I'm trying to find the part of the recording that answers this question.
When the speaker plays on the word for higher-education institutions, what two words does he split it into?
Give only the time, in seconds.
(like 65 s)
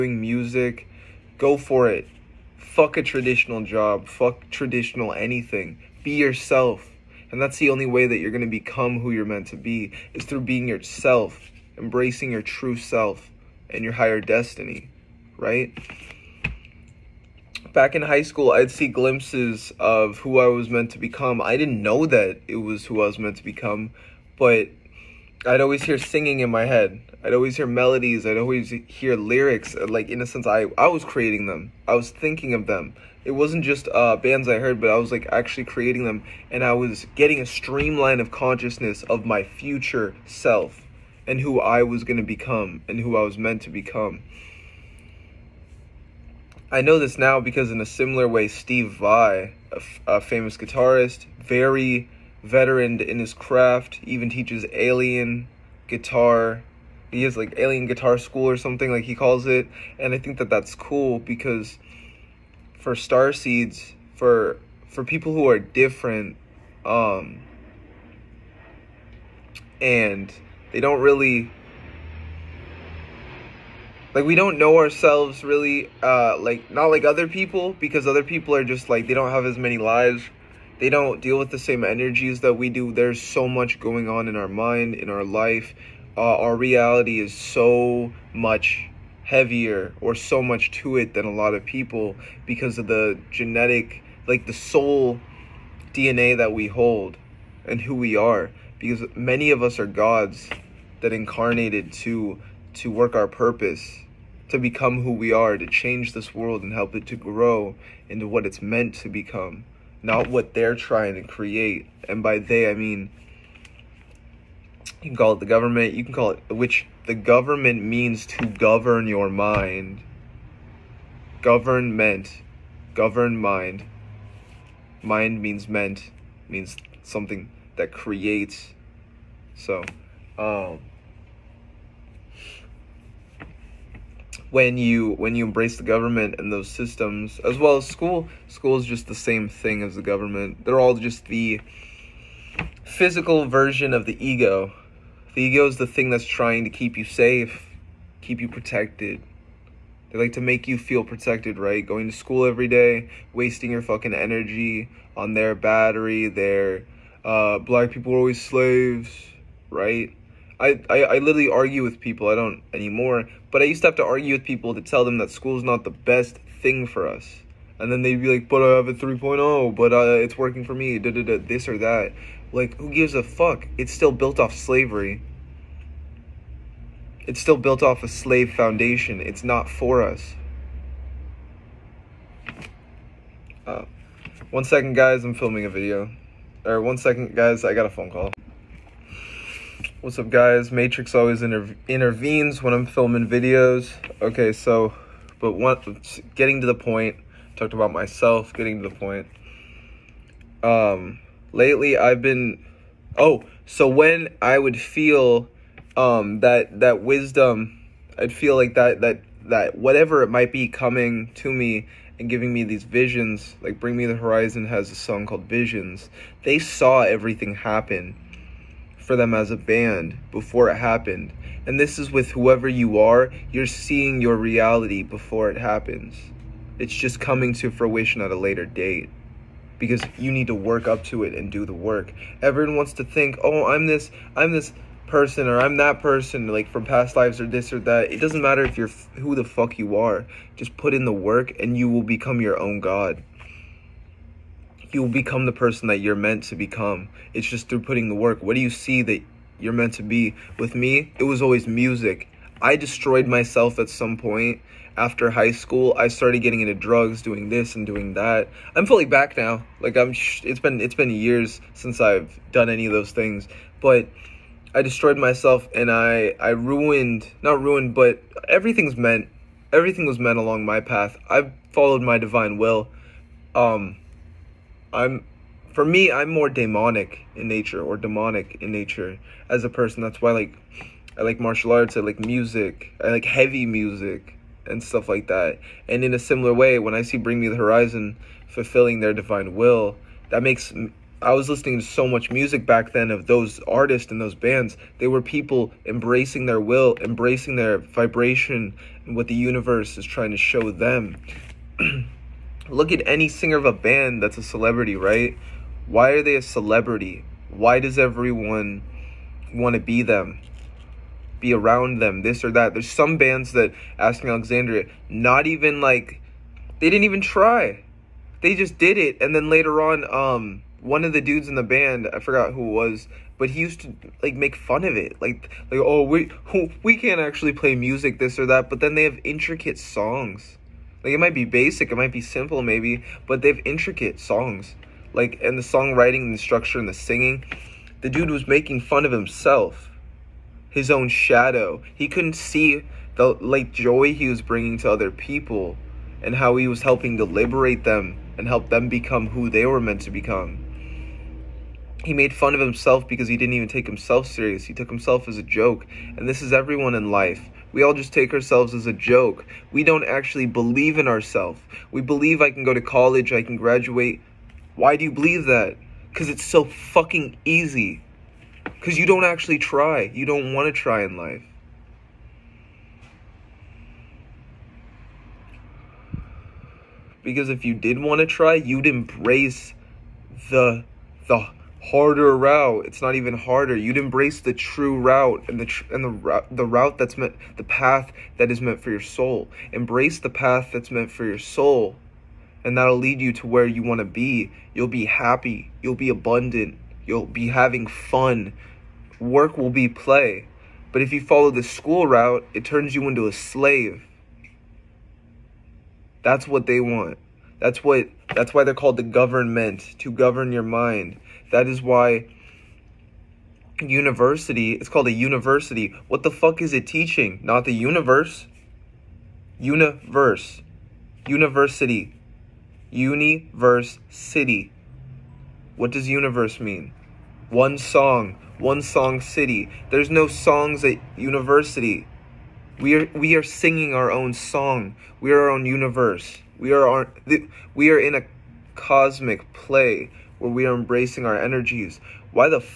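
422 s.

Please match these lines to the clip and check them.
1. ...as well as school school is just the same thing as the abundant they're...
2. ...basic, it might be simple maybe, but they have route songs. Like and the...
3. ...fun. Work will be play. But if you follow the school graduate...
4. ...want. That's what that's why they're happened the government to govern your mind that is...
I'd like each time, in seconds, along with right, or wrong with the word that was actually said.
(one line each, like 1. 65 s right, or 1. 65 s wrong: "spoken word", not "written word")
1. 137 s wrong: "government", not "abundant"
2. 331 s wrong: "intricate", not "route"
3. 397 s wrong: "route", not "graduate"
4. 406 s wrong: "called", not "happened".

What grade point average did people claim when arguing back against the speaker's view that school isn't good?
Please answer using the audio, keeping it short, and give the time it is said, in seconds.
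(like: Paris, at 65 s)
3.0, at 168 s.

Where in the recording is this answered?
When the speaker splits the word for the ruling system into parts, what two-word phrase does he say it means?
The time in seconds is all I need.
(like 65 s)
122 s.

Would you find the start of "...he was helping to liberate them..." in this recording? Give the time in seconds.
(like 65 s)
346 s.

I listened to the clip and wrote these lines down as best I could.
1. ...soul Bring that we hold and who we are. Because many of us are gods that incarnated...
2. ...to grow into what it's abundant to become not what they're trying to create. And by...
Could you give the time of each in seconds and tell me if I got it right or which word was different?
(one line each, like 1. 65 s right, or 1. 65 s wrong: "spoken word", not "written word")
1. 94 s wrong: "DNA", not "Bring"
2. 107 s wrong: "meant", not "abundant".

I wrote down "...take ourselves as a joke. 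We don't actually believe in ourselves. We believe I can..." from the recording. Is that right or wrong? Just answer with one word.
right.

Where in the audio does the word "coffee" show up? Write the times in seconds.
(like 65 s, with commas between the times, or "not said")
not said.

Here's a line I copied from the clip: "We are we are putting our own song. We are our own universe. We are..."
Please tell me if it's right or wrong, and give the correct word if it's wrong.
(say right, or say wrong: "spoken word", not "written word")
wrong: "singing", not "putting".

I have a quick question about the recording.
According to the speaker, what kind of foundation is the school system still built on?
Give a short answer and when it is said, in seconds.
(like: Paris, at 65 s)
a slave foundation, at 178 s.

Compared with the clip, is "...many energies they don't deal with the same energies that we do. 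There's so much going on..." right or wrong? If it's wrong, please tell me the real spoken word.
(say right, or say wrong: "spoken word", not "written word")
wrong: "lives", not "energies".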